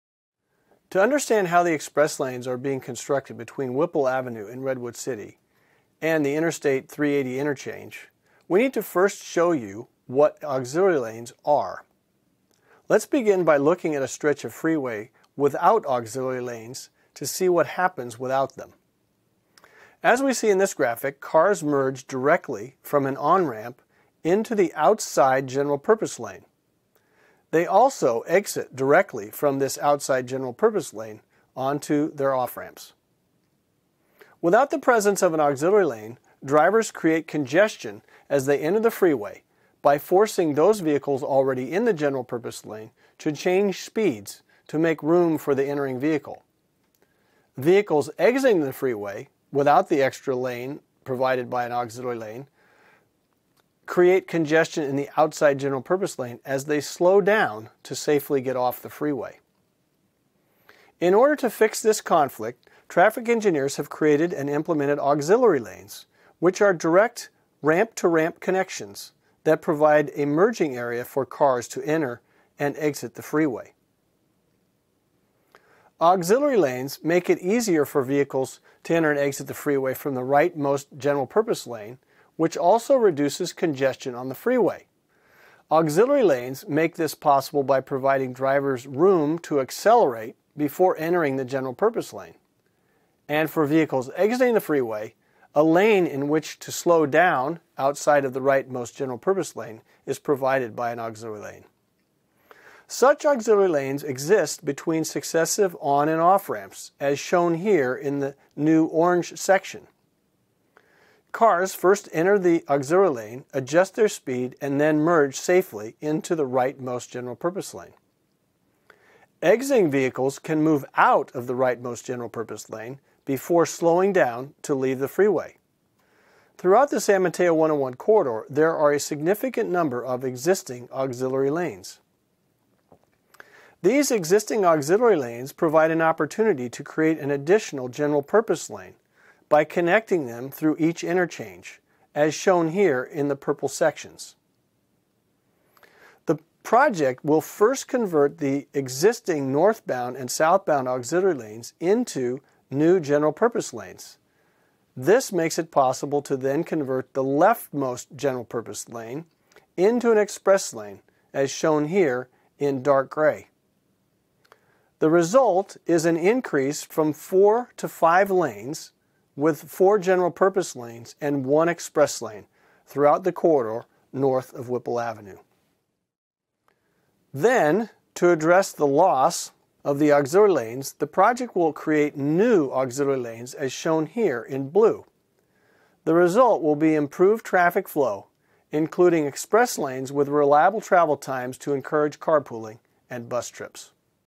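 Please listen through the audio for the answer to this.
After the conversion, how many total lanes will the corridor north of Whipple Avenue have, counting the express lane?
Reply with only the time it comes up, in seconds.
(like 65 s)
167 s.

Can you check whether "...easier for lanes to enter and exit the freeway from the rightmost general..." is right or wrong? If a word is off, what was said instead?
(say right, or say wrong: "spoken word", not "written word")
wrong: "vehicles", not "lanes".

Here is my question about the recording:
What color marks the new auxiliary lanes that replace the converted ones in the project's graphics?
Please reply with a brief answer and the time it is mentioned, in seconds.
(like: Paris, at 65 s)
blue, at 184 s.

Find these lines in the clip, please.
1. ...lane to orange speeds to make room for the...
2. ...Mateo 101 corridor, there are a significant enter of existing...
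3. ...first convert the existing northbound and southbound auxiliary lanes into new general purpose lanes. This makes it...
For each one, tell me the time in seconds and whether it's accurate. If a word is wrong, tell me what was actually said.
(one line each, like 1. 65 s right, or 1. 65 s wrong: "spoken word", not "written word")
1. 42 s wrong: "change", not "orange"
2. 127 s wrong: "number", not "enter"
3. 147 s right.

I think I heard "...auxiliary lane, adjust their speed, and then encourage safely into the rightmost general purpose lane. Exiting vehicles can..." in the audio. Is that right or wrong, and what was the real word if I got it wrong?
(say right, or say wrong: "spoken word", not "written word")
wrong: "merge", not "encourage".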